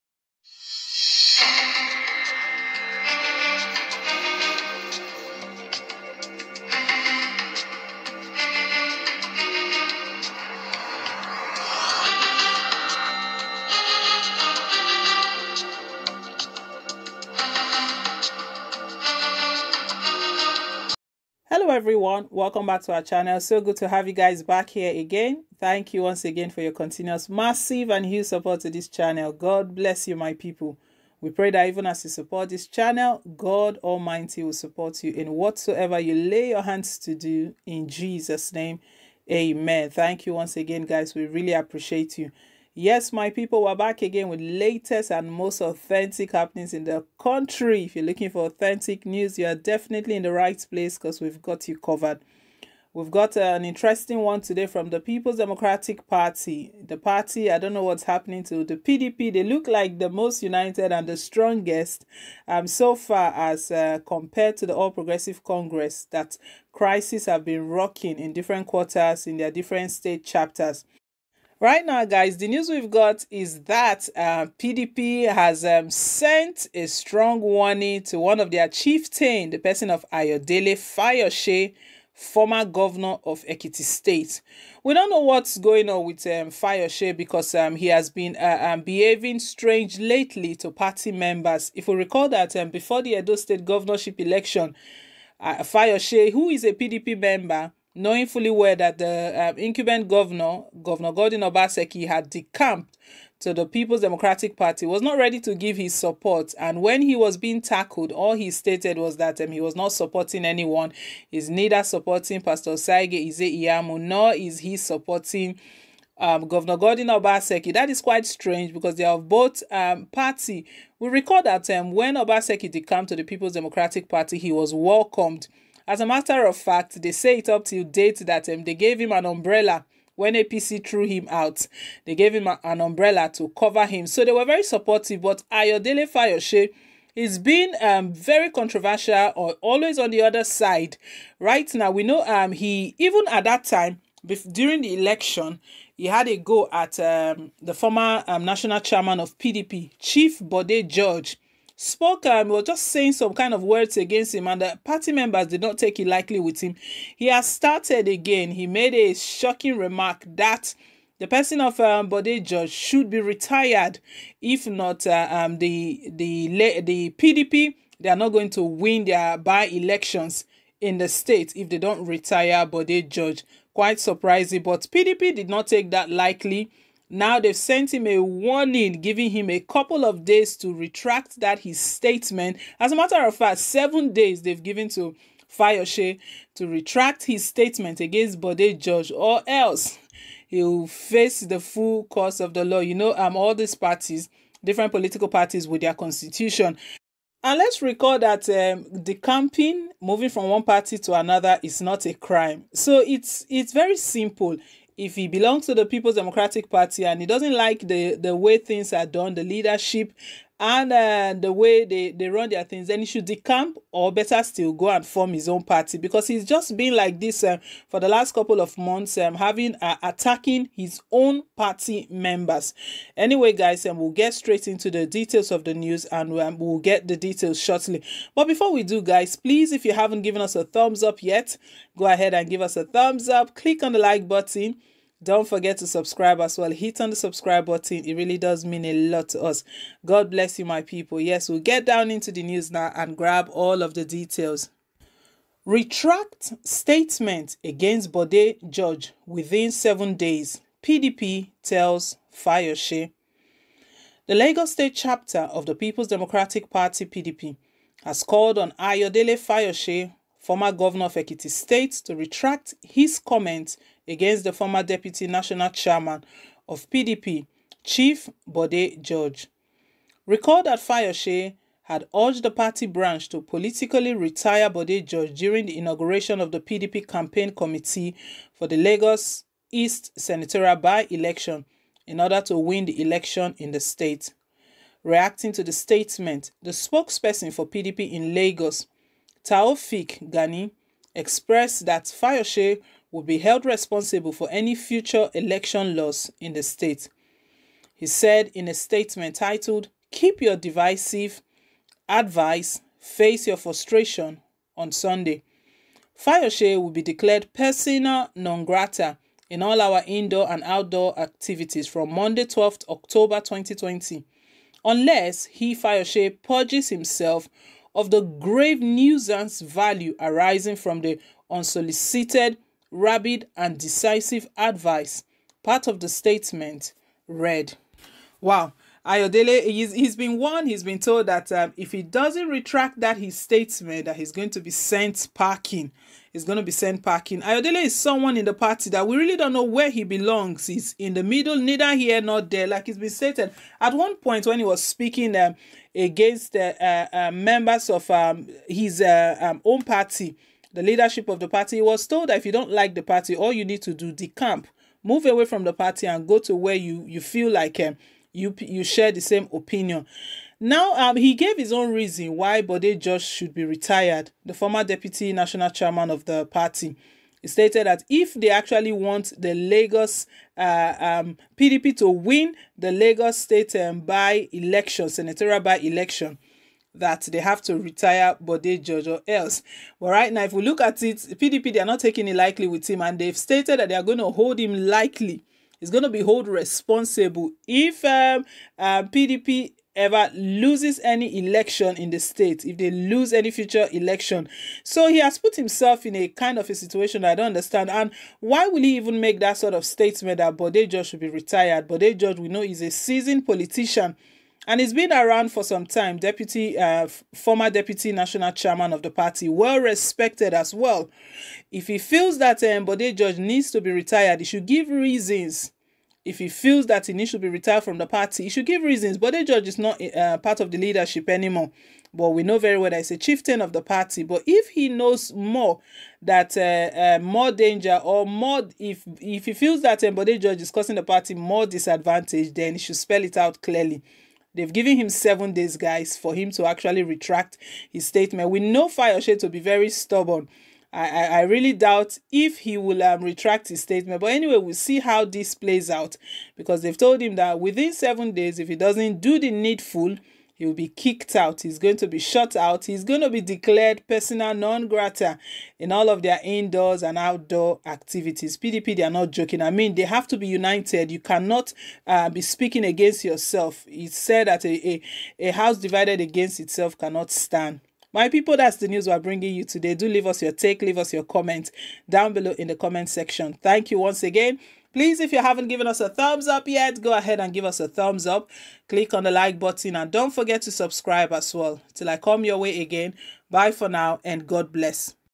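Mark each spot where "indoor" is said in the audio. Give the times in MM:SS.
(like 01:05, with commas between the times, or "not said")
05:10, 07:36.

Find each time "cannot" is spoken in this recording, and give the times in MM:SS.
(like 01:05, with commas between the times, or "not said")
07:41, 07:46.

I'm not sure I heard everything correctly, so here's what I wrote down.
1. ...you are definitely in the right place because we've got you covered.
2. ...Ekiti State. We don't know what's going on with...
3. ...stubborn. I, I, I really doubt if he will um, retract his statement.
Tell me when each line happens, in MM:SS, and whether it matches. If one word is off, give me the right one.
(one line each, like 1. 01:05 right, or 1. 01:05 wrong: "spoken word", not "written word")
1. 00:49 right
2. 01:23 right
3. 07:19 right.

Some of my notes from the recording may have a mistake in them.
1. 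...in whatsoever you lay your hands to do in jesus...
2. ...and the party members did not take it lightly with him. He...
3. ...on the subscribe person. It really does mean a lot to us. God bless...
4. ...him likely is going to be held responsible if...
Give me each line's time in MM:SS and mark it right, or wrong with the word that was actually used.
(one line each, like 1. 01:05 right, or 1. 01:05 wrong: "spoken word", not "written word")
1. 00:35 right
2. 02:34 right
3. 03:56 wrong: "button", not "person"
4. 06:24 right.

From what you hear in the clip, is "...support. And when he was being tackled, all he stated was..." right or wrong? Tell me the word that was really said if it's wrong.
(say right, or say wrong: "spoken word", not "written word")
right.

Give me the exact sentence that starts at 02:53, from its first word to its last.
Quite surprising, but PDP did not take that lightly.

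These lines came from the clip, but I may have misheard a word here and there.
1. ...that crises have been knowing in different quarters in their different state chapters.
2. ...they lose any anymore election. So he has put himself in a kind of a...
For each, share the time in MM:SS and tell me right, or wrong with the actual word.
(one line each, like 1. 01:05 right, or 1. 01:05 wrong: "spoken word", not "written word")
1. 01:06 wrong: "rocking", not "knowing"
2. 06:32 wrong: "future", not "anymore".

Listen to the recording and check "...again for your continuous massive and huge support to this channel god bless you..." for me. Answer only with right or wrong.
right.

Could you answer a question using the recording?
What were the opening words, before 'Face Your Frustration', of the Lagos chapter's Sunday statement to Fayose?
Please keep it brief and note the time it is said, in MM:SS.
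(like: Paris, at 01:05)
Keep Your Divisive Advice, at 05:00.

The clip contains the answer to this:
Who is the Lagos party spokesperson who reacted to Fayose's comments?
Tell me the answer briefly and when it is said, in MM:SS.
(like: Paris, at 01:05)
Taofiq Gani, at 04:49.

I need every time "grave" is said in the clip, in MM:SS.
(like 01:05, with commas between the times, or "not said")
05:18.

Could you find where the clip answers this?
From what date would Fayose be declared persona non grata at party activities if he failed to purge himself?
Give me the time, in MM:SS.
05:12.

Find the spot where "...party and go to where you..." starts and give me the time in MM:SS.
05:55.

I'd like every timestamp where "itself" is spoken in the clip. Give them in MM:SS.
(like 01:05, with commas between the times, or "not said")
07:46.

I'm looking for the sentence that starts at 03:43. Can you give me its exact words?
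Anyway, guys, and um, we'll get straight into the details of the news and um, we'll get the details shortly.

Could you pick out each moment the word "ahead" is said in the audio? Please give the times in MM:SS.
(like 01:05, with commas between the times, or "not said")
03:52, 07:57.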